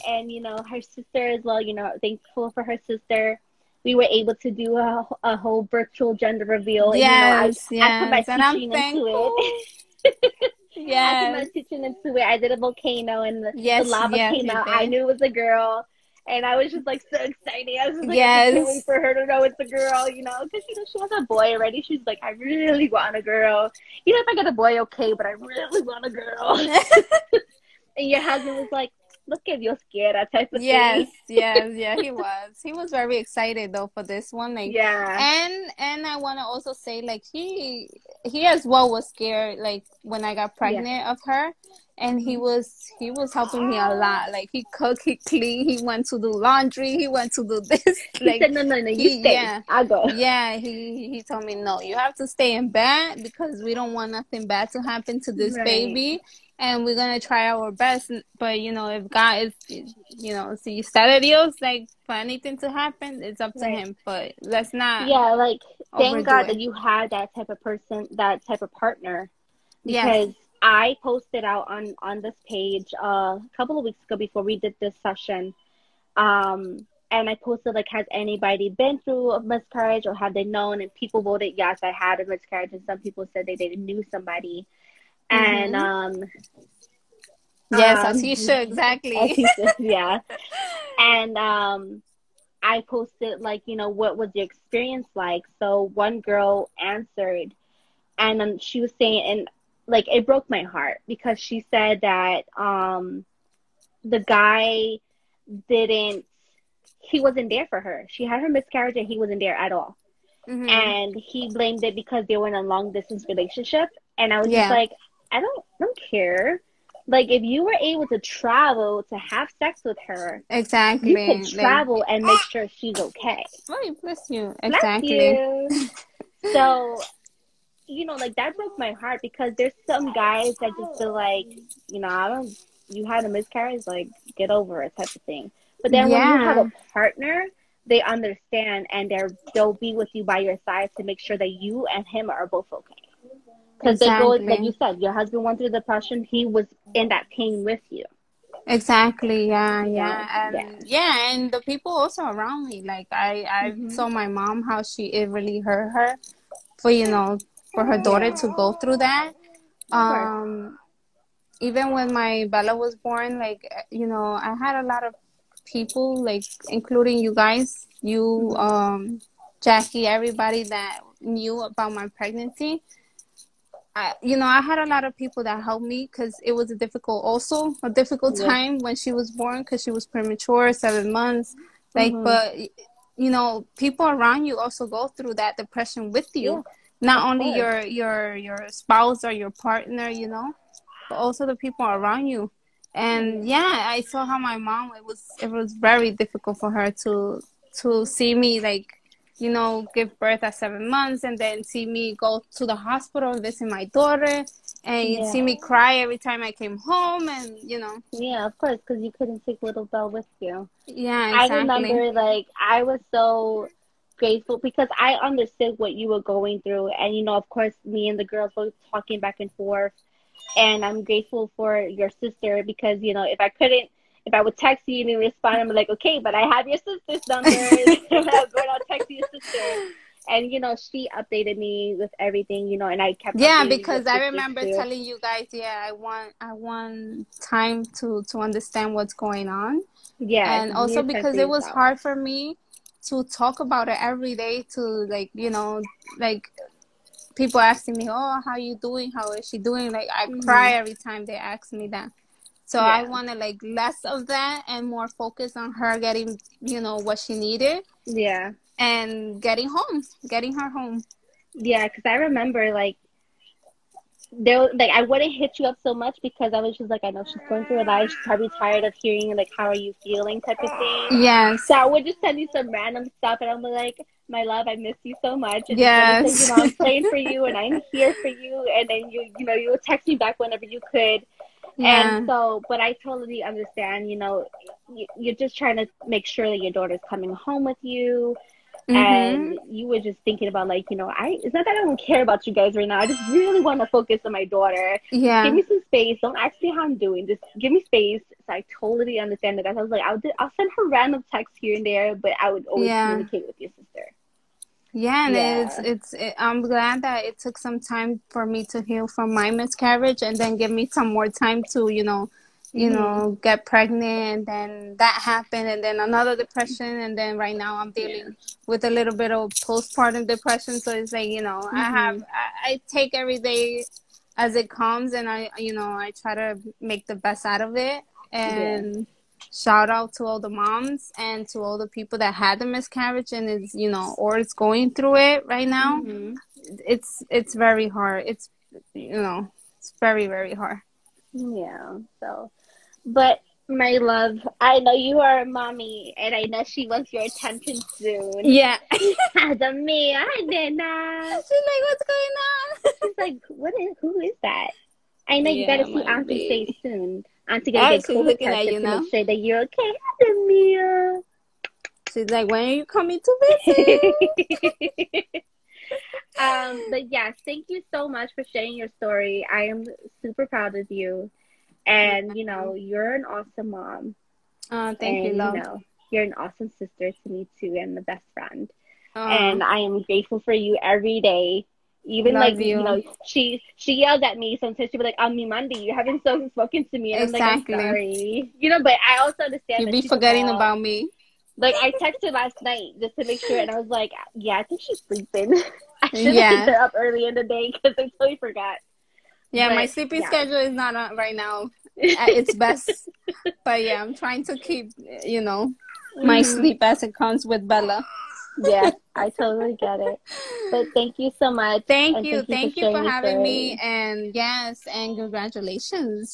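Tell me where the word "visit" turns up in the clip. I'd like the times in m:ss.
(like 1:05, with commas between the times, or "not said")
3:23, 6:03.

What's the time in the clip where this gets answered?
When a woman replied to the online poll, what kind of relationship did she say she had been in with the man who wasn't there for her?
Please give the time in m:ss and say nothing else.
1:52.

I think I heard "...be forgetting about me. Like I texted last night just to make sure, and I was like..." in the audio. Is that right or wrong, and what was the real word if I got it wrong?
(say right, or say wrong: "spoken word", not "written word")
right.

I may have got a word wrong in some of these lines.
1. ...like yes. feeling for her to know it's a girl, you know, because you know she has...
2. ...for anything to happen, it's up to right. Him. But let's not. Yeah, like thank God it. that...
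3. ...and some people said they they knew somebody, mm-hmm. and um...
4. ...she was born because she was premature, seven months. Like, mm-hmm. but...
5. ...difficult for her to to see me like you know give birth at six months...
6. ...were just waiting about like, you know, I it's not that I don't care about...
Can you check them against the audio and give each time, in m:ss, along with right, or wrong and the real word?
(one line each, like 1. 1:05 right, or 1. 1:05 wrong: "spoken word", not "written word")
1. 0:18 wrong: "waiting", not "feeling"
2. 1:02 right
3. 1:22 right
4. 2:58 right
5. 3:16 wrong: "seven", not "six"
6. 4:49 wrong: "thinking", not "waiting".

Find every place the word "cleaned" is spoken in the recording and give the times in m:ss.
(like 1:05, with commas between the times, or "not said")
0:45.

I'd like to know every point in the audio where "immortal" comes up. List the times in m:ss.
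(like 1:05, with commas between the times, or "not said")
not said.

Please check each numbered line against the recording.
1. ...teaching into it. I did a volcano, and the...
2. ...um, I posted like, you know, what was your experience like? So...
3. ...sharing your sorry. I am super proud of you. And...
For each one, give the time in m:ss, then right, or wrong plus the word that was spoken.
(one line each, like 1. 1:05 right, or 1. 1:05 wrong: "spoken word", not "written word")
1. 0:11 right
2. 1:31 right
3. 6:08 wrong: "story", not "sorry".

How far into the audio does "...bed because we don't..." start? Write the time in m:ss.
0:52.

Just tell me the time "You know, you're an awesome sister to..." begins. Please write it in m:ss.
6:15.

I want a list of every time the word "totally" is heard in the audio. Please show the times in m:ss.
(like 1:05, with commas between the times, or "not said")
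4:42, 4:58, 6:38, 6:49.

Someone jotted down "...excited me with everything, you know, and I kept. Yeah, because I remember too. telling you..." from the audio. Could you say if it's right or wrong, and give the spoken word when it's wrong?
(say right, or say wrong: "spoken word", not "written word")
wrong: "updated", not "excited".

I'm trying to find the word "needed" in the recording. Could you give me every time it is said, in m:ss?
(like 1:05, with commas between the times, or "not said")
4:17.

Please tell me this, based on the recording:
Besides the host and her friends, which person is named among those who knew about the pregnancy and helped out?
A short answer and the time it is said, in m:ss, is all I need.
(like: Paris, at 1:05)
Jackie, at 2:49.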